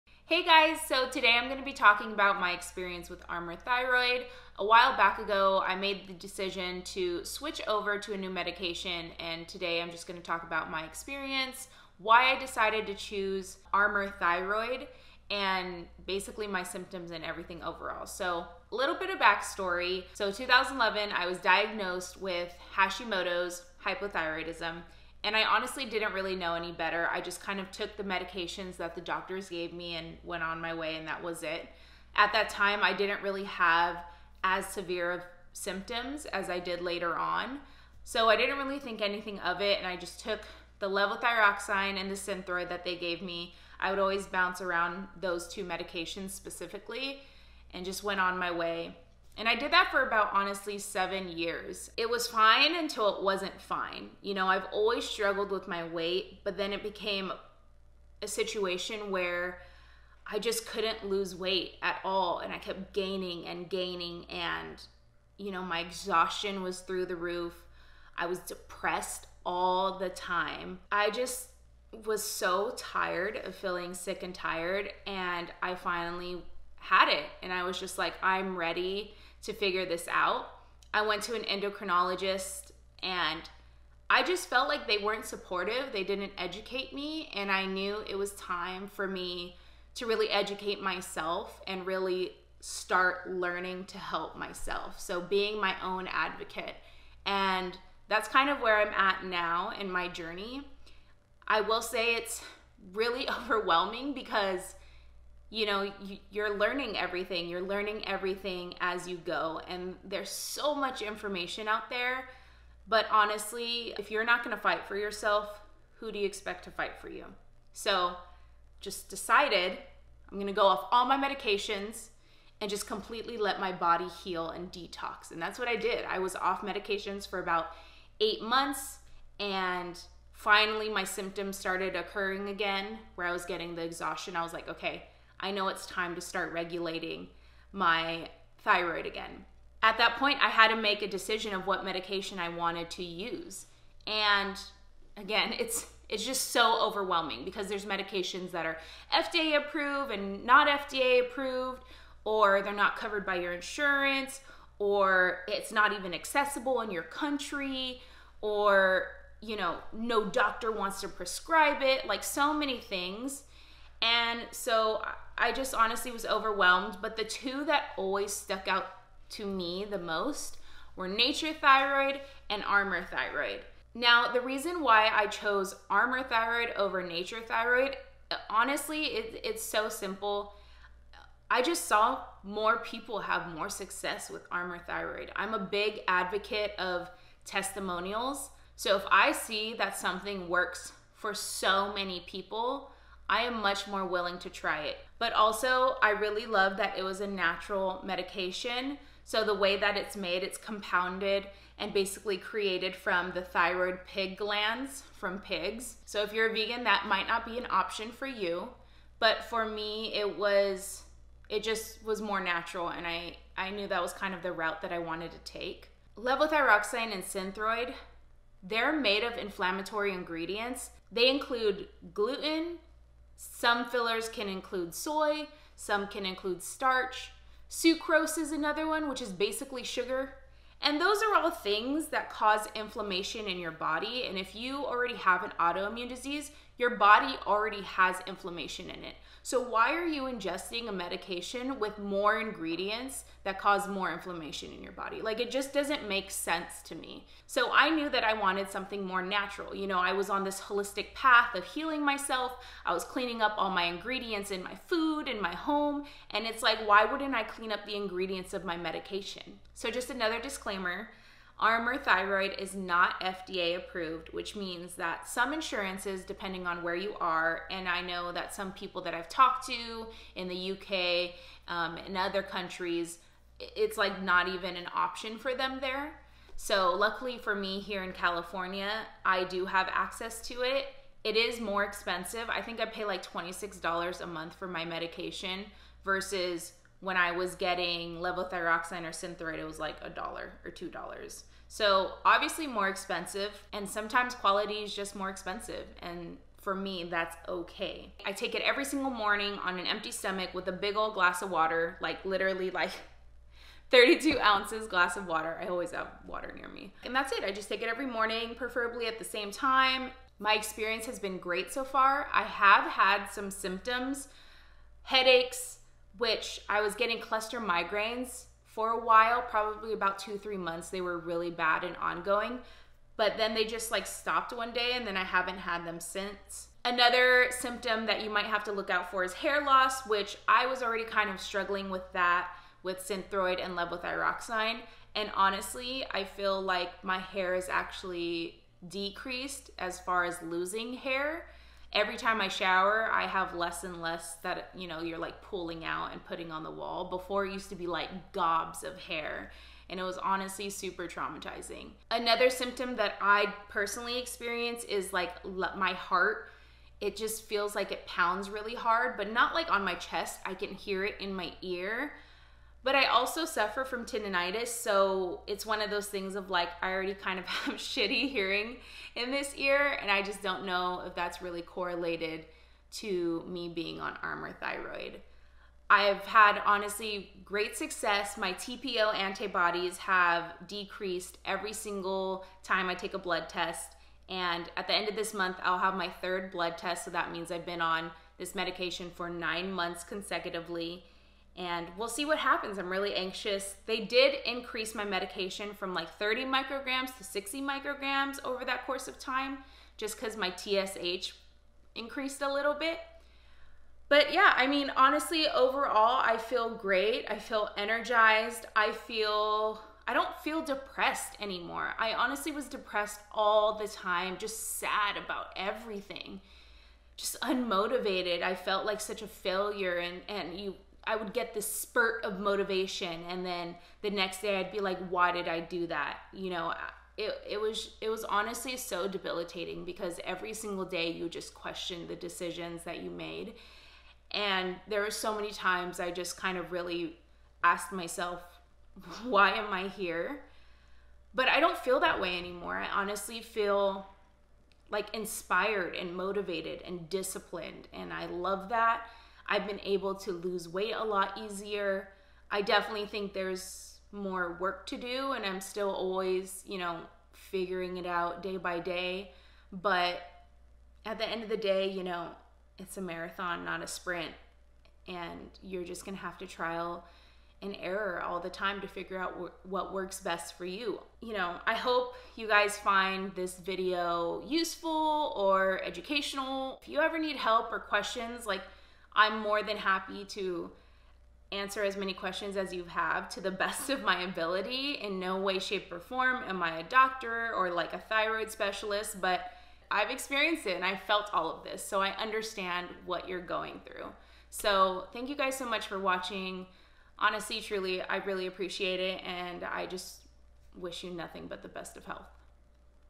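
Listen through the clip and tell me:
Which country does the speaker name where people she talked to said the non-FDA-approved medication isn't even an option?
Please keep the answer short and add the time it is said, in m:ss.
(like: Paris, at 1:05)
UK, at 4:30.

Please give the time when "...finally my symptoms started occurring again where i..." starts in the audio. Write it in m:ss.
2:10.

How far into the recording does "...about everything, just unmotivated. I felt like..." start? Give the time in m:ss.
6:55.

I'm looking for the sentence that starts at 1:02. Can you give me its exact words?
And I kept gaining and gaining.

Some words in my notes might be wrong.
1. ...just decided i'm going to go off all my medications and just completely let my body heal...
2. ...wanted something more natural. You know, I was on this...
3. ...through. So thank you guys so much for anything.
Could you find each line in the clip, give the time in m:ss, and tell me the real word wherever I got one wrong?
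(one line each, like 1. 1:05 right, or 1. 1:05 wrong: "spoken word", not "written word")
1. 1:58 right
2. 4:08 right
3. 8:13 wrong: "watching", not "anything".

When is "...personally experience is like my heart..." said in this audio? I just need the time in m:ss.
5:53.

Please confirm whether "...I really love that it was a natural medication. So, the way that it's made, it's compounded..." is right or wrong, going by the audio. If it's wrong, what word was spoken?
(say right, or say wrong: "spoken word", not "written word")
right.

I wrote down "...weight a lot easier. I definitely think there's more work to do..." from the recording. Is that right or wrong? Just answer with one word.
right.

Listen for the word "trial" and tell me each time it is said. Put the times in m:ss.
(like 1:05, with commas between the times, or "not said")
7:46.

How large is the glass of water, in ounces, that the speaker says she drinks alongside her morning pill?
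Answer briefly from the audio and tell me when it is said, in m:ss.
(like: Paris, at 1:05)
32 ounces, at 5:03.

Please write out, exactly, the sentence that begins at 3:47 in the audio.
Sucrose is another one, which is basically sugar.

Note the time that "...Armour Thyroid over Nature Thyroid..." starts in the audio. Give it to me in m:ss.
2:55.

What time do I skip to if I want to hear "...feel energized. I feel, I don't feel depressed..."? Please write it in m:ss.
6:47.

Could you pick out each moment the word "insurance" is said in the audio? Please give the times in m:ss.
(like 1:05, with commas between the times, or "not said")
2:33, 4:25.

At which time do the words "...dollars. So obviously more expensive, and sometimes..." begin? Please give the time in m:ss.
4:50.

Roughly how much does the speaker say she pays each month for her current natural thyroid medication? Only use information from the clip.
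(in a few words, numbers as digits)
$26.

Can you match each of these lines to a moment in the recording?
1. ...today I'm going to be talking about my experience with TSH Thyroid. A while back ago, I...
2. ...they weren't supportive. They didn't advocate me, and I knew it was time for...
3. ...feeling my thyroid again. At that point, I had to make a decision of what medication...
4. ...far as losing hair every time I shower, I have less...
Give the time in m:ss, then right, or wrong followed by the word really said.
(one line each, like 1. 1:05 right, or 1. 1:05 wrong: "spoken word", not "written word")
1. 0:01 wrong: "Armour", not "TSH"
2. 1:24 wrong: "educate", not "advocate"
3. 2:16 wrong: "regulating", not "feeling"
4. 5:39 right.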